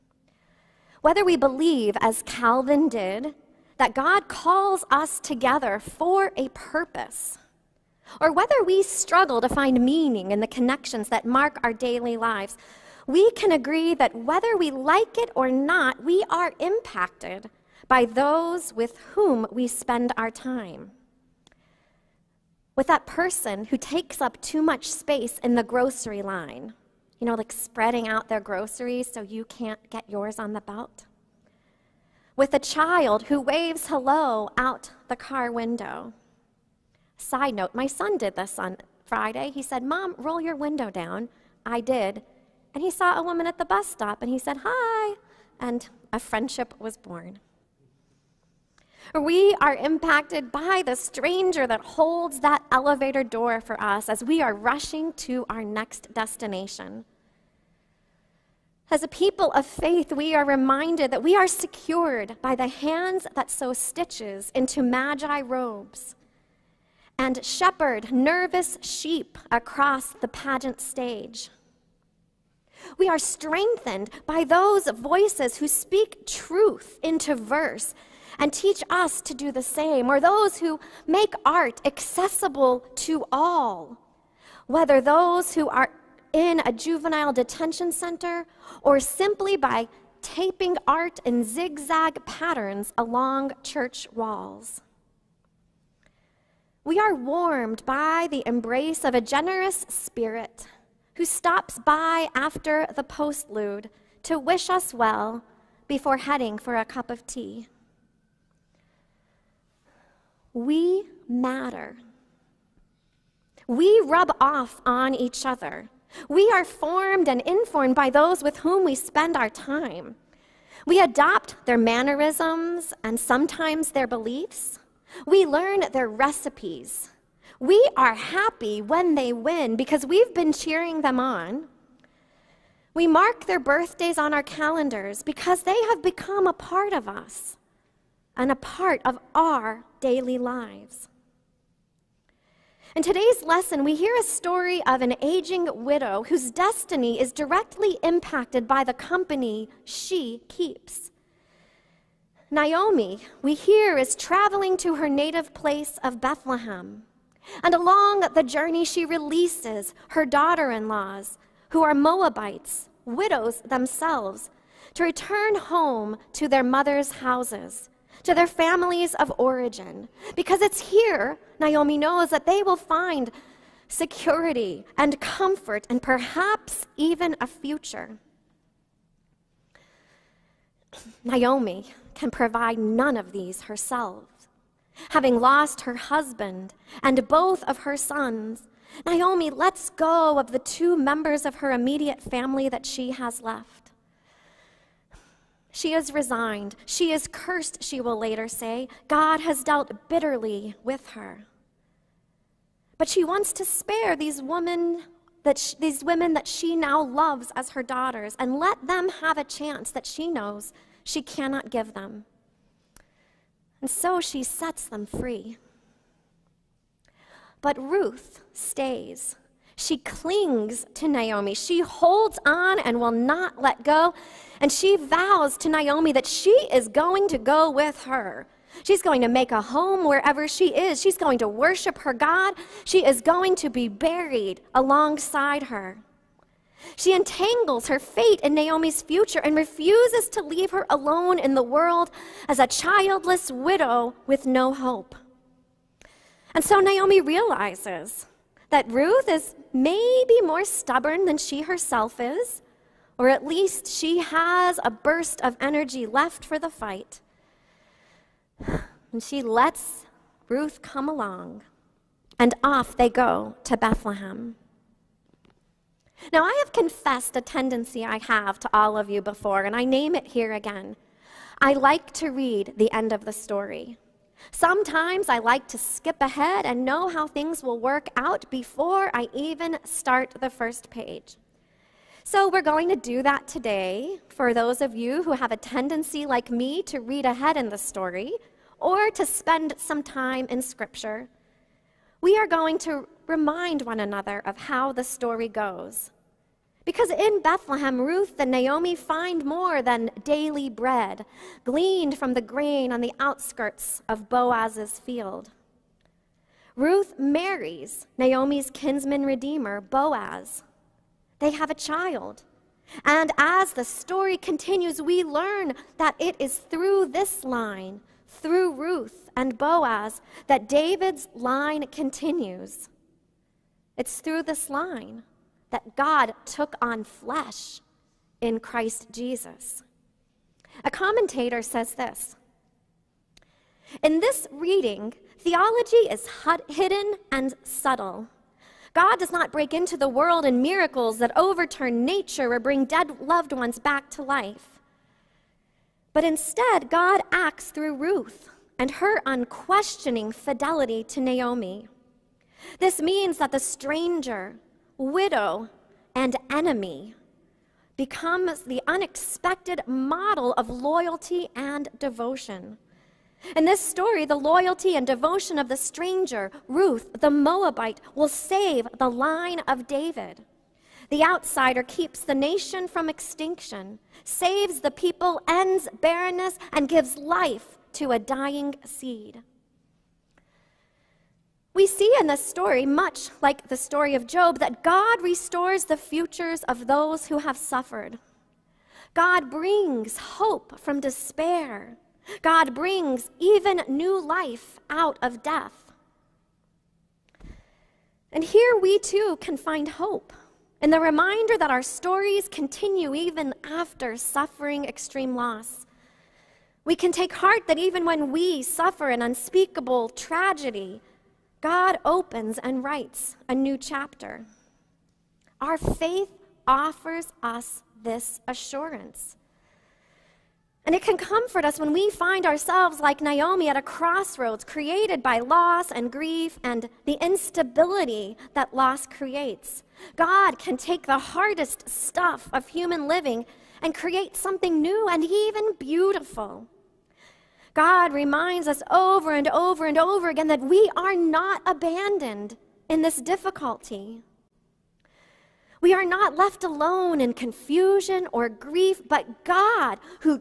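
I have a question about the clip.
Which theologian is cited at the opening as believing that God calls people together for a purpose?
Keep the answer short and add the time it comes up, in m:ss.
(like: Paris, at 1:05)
Calvin, at 0:02.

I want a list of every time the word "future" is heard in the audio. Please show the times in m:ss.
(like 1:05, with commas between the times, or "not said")
2:57, 3:59, 6:25.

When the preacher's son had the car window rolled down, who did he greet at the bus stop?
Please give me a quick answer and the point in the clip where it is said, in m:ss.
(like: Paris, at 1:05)
a woman, at 0:43.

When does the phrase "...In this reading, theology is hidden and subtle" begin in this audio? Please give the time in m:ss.
5:34.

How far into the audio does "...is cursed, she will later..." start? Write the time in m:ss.
3:17.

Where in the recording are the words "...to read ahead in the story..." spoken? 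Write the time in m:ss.
4:46.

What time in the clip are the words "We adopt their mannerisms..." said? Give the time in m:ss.
2:00.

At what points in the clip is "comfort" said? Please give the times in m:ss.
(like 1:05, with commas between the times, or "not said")
2:55, 7:01.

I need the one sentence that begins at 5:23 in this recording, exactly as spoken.
It's through this line that God took on flesh in Christ Jesus.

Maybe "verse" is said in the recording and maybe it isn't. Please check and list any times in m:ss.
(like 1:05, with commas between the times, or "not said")
1:17.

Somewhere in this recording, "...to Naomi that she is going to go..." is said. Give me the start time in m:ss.
3:45.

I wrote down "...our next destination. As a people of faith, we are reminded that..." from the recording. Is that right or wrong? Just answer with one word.
right.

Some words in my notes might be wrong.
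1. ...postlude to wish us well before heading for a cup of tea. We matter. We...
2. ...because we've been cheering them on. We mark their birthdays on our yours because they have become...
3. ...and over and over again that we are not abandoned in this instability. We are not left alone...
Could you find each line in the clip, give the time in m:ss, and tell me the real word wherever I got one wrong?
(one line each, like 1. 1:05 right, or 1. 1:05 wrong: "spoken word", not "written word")
1. 1:43 right
2. 2:09 wrong: "calendars", not "yours"
3. 7:19 wrong: "difficulty", not "instability".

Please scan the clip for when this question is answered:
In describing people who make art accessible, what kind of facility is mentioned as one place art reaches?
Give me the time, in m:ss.
1:26.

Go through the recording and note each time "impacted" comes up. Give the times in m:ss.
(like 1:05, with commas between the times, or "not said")
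0:16, 0:49, 2:28.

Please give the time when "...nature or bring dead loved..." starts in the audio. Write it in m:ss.
5:42.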